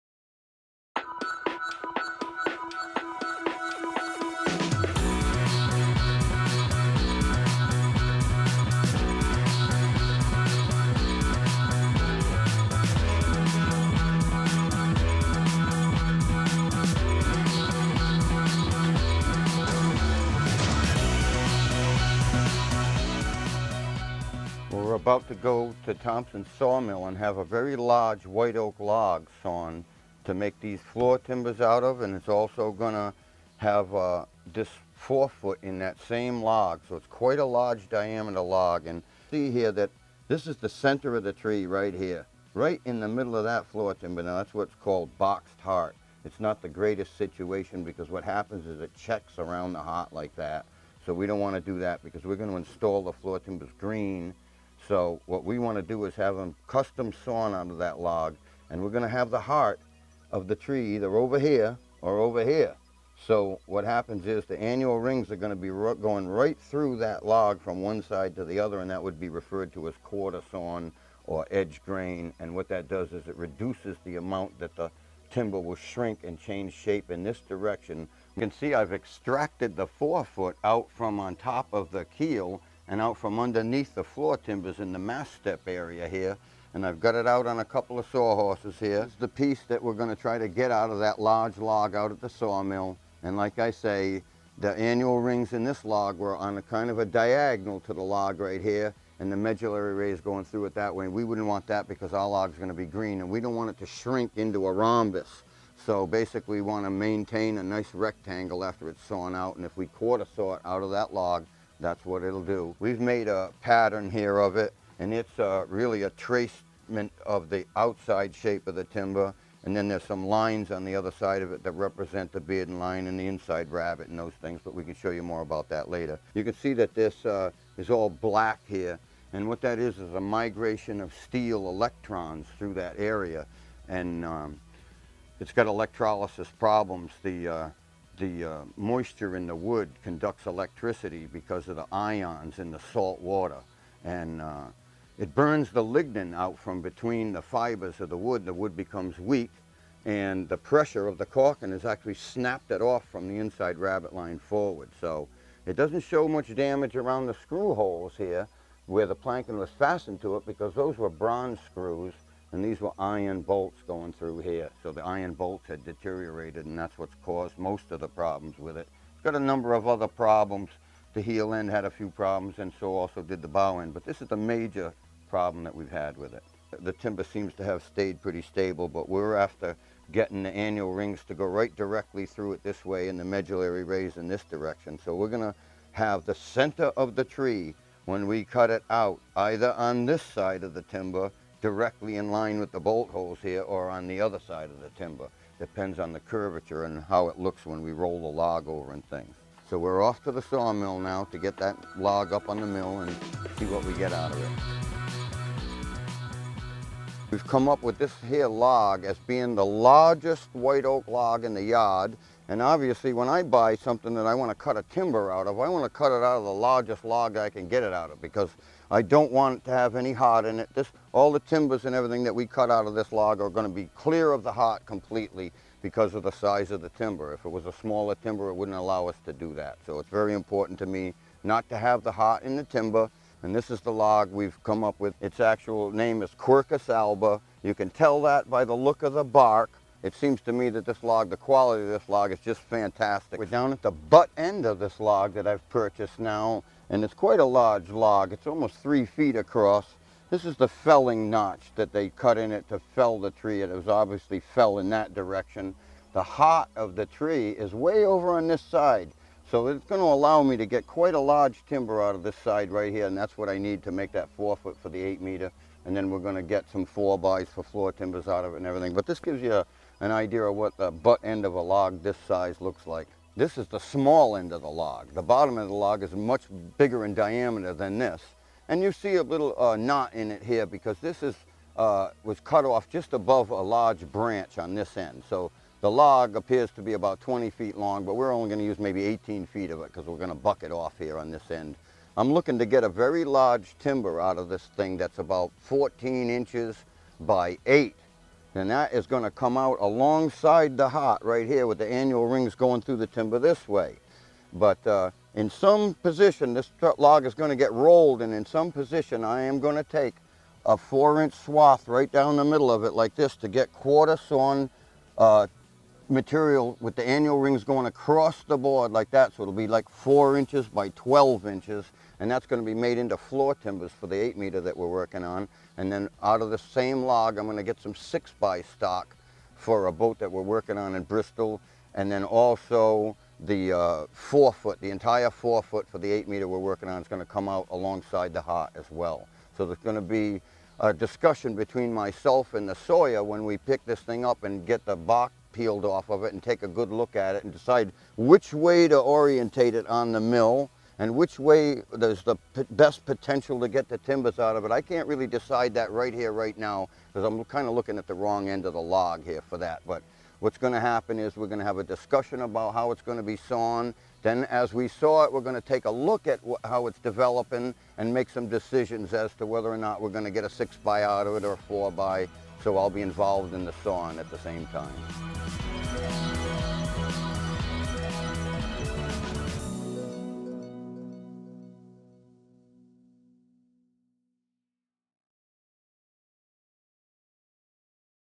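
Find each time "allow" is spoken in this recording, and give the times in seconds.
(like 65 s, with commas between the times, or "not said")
228 s, 260 s.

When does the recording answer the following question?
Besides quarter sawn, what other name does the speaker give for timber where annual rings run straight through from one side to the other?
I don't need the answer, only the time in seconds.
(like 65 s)
71 s.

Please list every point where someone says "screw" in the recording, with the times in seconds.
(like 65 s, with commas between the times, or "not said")
157 s, 161 s.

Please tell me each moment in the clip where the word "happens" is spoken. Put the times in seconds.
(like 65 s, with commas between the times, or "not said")
48 s, 63 s, 360 s.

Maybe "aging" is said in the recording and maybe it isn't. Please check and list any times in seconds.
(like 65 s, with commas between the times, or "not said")
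not said.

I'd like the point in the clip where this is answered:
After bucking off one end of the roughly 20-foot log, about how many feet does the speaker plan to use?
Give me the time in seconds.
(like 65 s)
289 s.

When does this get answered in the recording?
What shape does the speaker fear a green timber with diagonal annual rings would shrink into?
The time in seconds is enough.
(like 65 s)
104 s.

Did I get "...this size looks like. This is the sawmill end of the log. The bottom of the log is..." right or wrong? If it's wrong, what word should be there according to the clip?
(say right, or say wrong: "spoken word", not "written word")
wrong: "small", not "sawmill".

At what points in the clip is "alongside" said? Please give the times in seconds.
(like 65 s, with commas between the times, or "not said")
299 s, 337 s.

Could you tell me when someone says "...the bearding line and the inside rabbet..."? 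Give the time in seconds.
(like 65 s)
122 s.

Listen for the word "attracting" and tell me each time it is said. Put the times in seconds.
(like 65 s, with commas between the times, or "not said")
not said.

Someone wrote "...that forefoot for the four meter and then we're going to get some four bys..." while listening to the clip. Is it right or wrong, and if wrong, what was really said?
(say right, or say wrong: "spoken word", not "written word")
wrong: "eight", not "four".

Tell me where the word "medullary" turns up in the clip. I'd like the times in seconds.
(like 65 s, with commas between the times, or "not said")
99 s, 183 s.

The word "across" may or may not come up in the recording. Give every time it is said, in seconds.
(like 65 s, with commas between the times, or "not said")
249 s, 317 s.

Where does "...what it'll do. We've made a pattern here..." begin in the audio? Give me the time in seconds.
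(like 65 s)
112 s.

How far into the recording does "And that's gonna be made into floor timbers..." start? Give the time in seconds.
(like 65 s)
322 s.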